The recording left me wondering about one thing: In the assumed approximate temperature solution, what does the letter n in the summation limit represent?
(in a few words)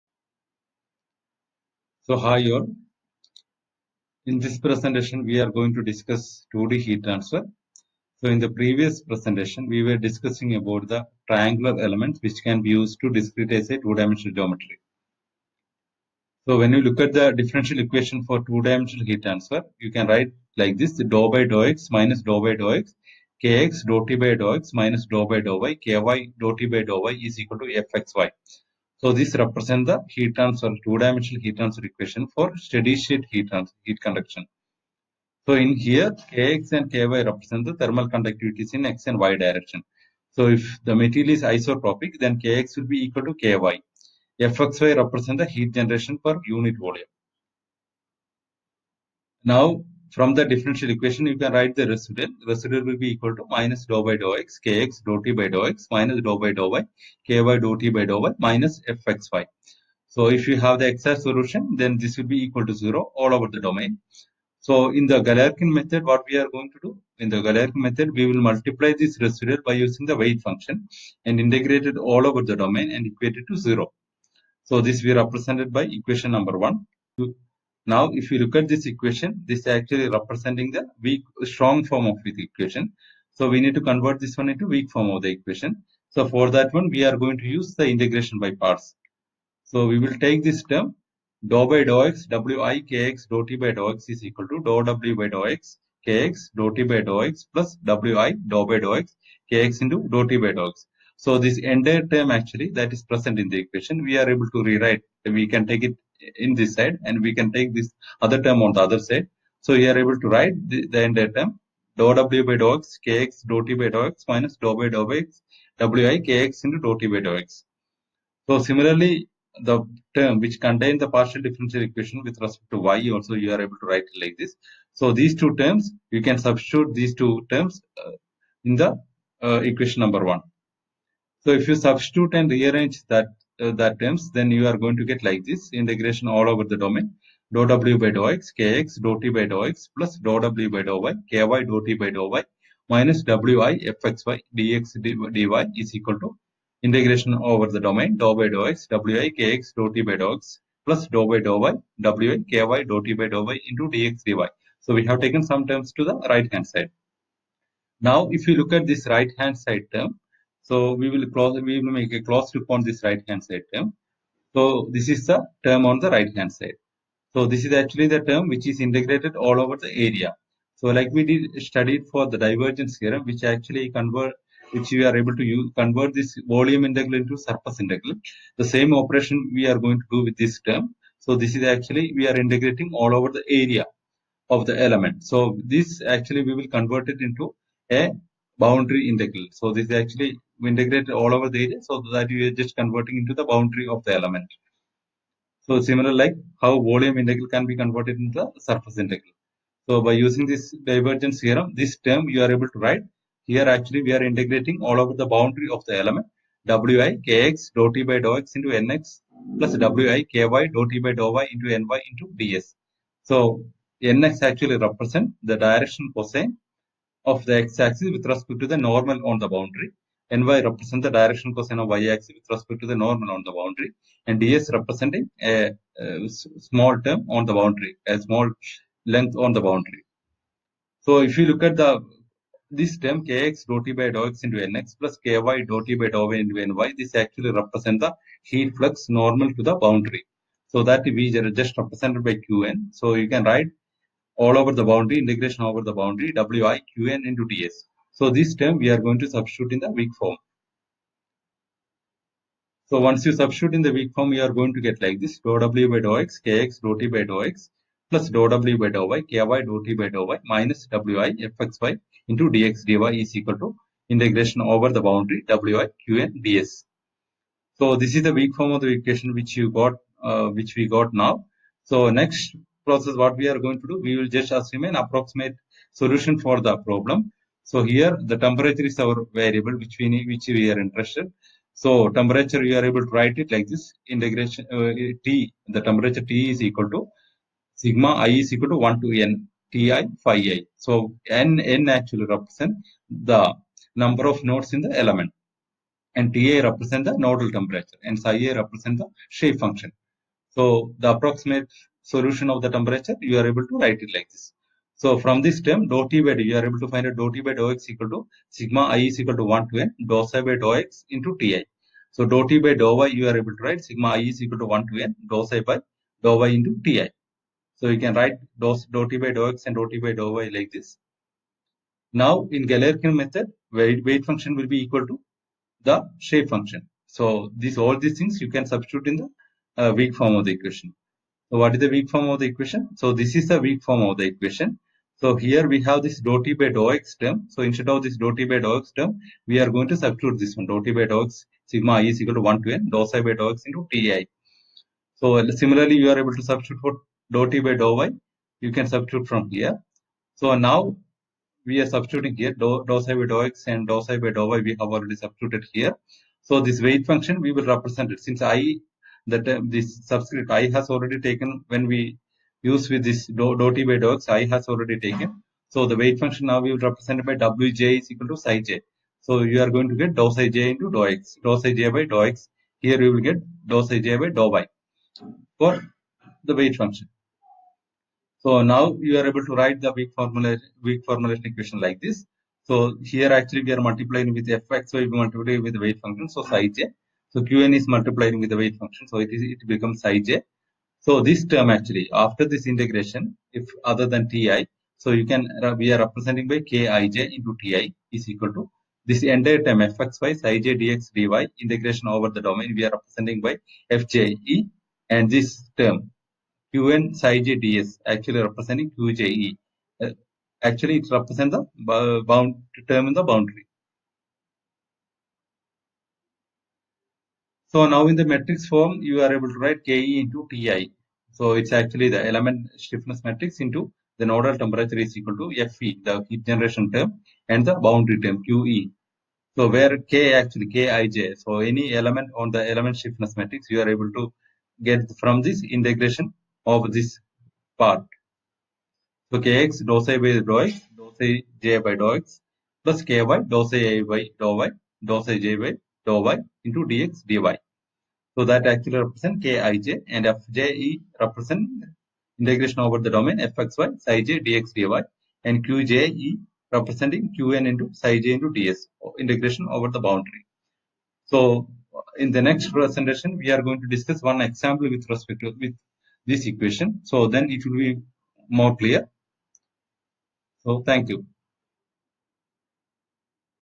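Number of nodes in the element.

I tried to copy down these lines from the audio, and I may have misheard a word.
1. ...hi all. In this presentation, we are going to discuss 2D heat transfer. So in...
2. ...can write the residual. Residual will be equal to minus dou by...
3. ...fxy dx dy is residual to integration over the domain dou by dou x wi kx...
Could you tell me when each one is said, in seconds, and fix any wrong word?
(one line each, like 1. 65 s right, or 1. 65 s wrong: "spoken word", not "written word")
1. 2 s right
2. 51 s right
3. 144 s wrong: "equal", not "residual".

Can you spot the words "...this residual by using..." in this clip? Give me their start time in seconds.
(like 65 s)
68 s.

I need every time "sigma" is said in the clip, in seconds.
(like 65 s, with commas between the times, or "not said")
287 s, 308 s, 313 s, 341 s.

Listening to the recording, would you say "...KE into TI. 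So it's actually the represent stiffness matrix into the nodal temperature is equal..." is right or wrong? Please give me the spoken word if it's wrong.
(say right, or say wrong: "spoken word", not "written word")
wrong: "element", not "represent".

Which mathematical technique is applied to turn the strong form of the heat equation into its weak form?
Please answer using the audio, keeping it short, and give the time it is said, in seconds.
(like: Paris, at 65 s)
Integration by parts, at 87 s.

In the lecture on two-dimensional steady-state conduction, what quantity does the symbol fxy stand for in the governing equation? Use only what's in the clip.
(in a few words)
Heat generation per unit volume.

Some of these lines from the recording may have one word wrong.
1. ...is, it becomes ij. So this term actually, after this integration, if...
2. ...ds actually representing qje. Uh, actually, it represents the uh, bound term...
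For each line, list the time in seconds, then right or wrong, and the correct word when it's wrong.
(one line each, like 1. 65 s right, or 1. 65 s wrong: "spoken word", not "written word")
1. 389 s right
2. 407 s right.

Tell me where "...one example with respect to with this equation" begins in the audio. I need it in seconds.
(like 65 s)
464 s.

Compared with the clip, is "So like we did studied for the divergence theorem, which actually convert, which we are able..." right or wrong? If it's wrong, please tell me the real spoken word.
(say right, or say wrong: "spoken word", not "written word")
right.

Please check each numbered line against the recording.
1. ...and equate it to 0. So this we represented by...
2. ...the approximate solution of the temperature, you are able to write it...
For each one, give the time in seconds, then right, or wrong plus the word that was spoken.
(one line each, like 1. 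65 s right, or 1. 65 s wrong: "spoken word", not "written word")
1. 72 s right
2. 301 s right.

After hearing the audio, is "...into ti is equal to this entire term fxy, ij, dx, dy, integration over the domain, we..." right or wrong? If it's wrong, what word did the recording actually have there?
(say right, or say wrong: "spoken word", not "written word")
right.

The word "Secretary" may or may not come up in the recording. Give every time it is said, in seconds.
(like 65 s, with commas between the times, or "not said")
not said.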